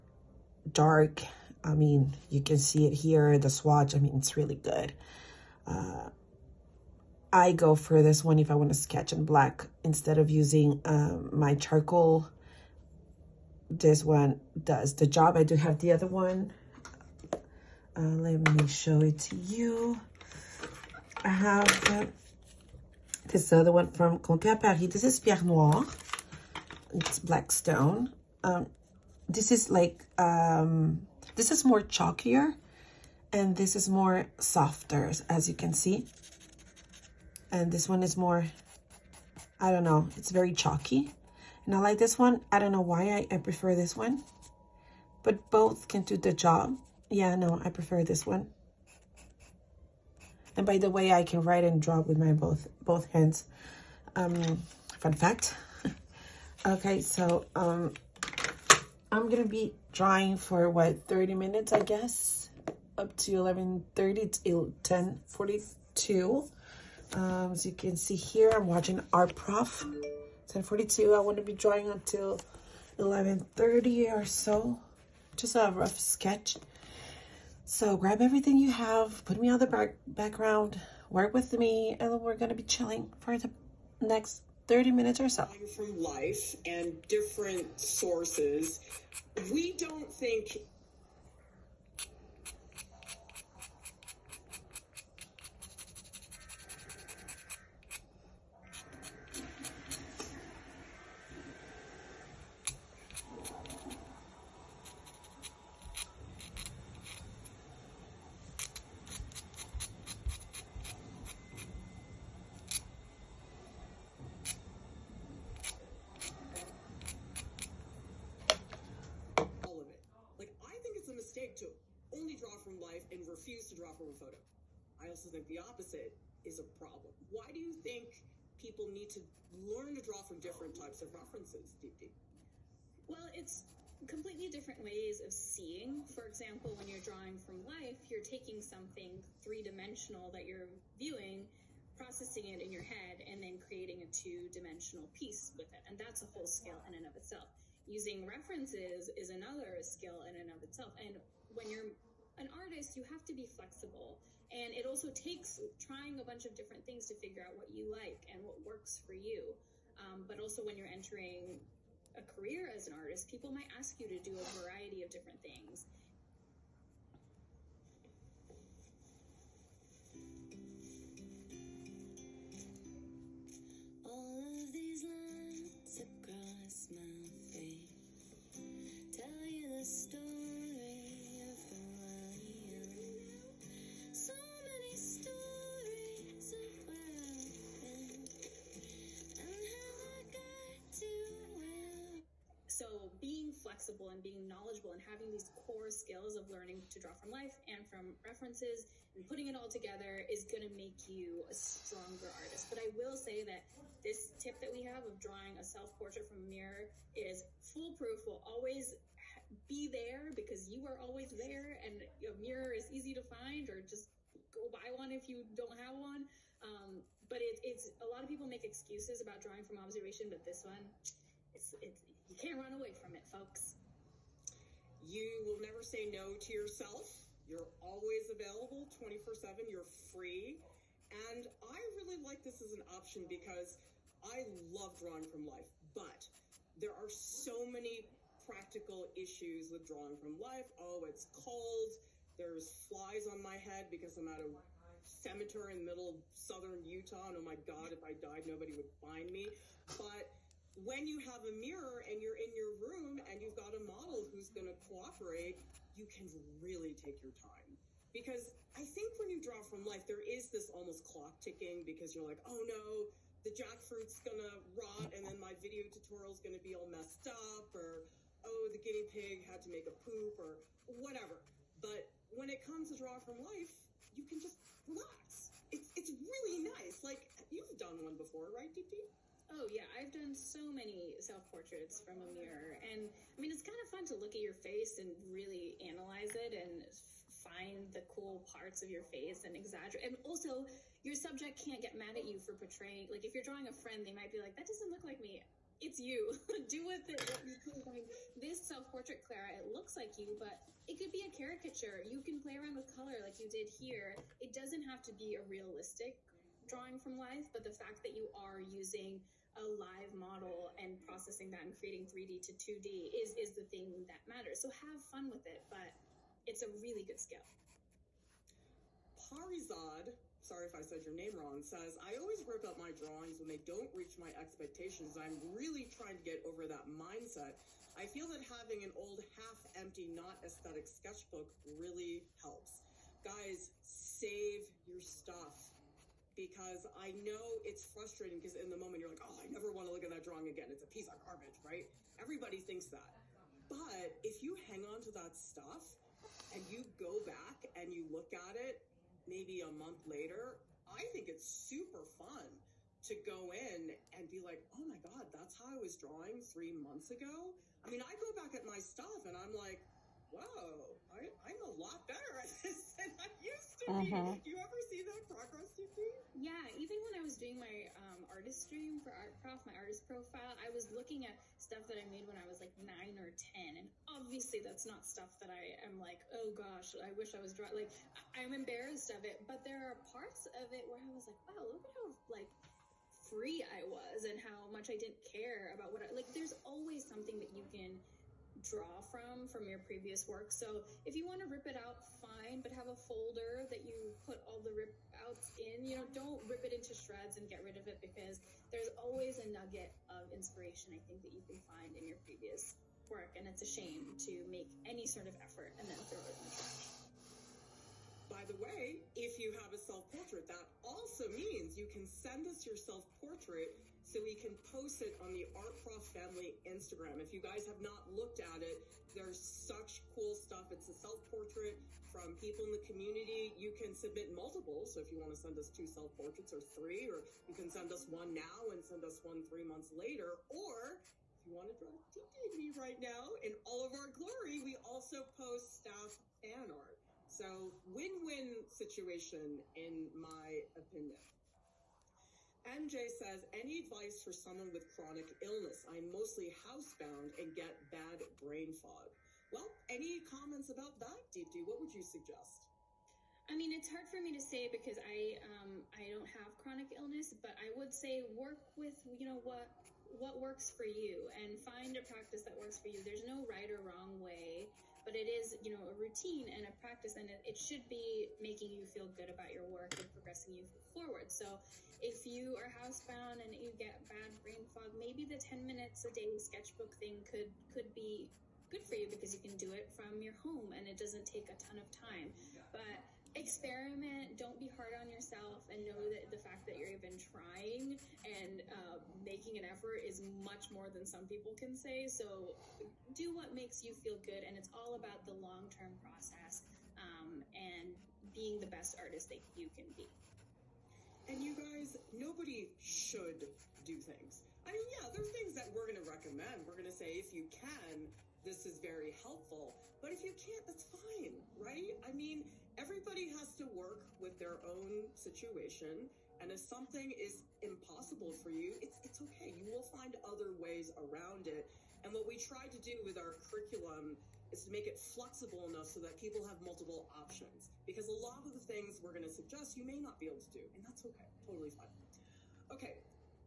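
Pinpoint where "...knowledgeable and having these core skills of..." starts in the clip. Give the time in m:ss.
3:14.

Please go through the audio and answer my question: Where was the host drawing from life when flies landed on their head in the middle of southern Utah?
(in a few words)
a cemetery.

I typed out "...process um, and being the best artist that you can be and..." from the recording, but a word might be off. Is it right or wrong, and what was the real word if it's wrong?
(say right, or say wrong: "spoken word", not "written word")
right.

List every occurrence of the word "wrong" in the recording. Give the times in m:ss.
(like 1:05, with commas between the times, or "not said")
5:21, 7:43.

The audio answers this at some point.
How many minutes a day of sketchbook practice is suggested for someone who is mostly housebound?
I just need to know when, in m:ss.
7:55.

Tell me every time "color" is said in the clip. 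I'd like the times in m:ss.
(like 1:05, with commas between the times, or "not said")
5:02.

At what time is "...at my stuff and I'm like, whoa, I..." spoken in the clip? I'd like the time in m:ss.
5:58.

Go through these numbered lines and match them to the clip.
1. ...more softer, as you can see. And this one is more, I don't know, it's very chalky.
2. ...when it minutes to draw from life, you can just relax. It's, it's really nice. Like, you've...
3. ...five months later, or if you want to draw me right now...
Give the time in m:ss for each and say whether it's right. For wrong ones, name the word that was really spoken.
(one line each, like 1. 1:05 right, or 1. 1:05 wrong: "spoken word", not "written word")
1. 0:33 right
2. 4:32 wrong: "comes", not "minutes"
3. 7:09 wrong: "three", not "five".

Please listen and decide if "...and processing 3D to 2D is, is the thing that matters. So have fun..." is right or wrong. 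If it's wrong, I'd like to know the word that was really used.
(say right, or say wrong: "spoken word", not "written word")
wrong: "creating", not "processing".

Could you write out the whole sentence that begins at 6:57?
If you guys have not looked at it, there's such cool stuff.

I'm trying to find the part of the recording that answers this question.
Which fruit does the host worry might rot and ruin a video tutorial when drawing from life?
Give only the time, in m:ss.
4:23.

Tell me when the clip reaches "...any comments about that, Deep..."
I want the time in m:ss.
7:29.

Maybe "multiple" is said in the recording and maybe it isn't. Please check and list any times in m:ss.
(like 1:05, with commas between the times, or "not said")
7:04, 8:46.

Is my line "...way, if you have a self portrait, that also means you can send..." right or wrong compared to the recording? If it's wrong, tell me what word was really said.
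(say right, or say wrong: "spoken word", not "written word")
right.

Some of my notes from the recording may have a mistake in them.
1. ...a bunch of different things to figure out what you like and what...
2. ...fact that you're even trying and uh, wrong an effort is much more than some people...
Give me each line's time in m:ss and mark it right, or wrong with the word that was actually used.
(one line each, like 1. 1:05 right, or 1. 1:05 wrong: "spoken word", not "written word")
1. 2:36 right
2. 8:06 wrong: "making", not "wrong".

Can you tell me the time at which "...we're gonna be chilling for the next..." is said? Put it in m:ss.
1:22.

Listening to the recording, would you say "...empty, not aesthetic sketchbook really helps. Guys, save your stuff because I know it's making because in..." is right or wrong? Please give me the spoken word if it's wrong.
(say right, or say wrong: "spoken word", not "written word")
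wrong: "frustrating", not "making".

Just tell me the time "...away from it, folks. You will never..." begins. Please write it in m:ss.
3:42.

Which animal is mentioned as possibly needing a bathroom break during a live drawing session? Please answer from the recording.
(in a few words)
guinea pig.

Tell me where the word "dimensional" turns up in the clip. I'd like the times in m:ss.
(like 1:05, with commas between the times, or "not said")
2:19, 2:24.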